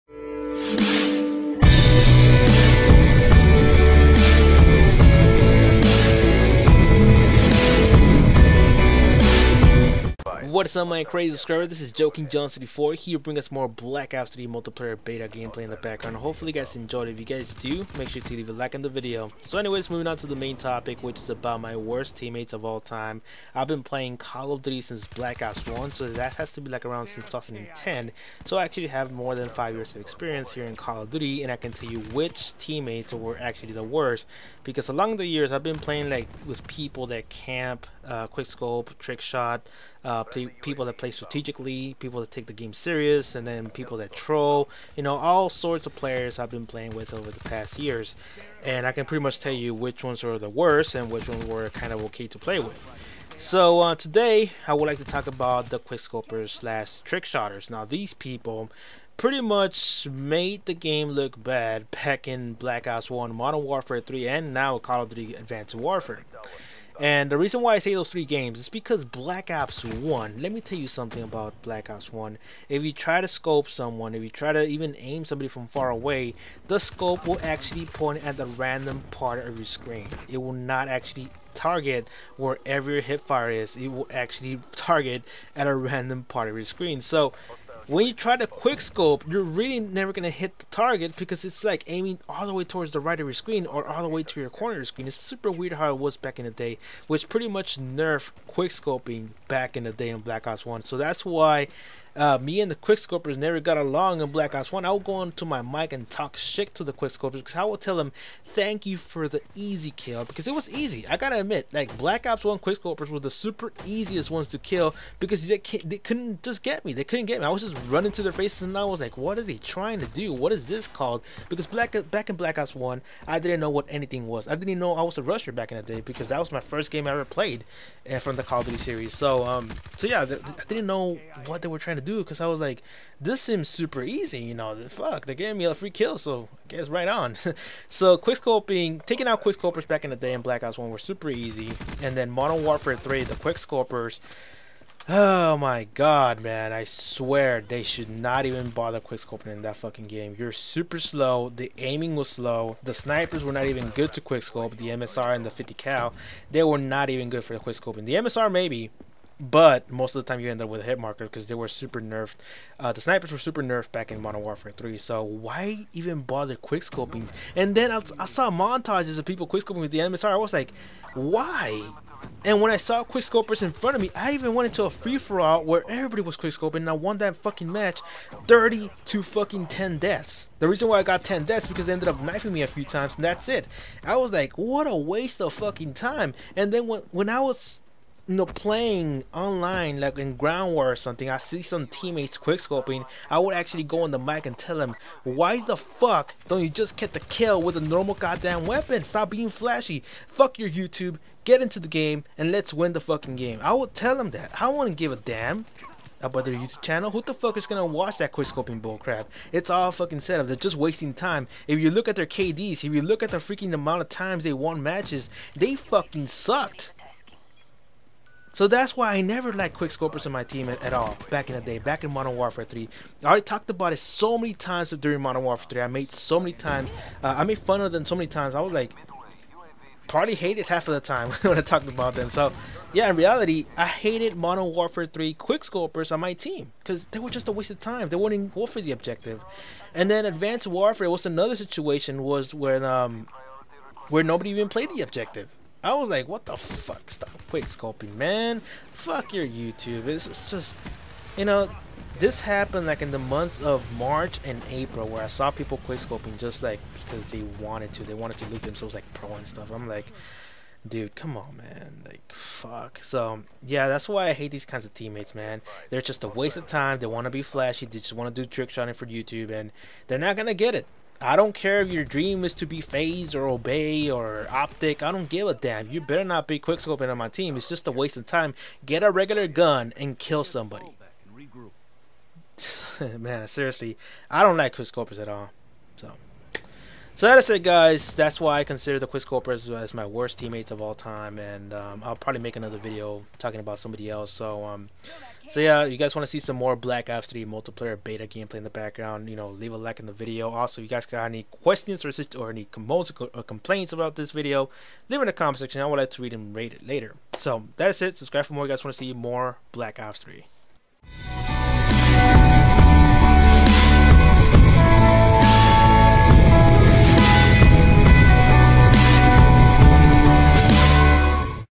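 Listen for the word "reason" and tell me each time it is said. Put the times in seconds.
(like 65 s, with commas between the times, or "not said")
67 s, 180 s.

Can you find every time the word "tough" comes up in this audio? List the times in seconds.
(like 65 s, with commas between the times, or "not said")
not said.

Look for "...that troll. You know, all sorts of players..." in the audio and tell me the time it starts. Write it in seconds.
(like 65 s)
43 s.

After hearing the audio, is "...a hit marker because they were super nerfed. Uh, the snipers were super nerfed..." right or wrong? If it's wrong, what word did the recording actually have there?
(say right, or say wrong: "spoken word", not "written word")
right.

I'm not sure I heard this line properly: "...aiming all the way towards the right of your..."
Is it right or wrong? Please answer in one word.
right.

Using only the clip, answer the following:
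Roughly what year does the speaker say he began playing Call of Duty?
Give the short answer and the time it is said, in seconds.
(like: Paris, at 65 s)
2010, at 27 s.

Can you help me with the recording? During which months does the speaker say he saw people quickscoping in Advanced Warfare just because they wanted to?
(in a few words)
March and April.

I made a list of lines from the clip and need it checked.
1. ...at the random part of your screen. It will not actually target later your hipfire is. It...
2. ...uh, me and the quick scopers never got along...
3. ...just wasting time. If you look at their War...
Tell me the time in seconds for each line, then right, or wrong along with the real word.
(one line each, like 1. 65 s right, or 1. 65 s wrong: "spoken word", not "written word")
1. 78 s wrong: "wherever", not "later"
2. 102 s right
3. 210 s wrong: "KDs", not "War".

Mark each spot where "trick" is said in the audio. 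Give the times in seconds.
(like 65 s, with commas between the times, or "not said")
38 s, 56 s, 268 s.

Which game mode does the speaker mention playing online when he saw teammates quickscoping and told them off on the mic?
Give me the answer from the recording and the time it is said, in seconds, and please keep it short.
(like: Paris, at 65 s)
Ground War, at 190 s.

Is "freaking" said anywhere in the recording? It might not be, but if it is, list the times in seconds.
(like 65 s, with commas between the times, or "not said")
213 s.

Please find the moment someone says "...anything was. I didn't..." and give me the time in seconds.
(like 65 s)
123 s.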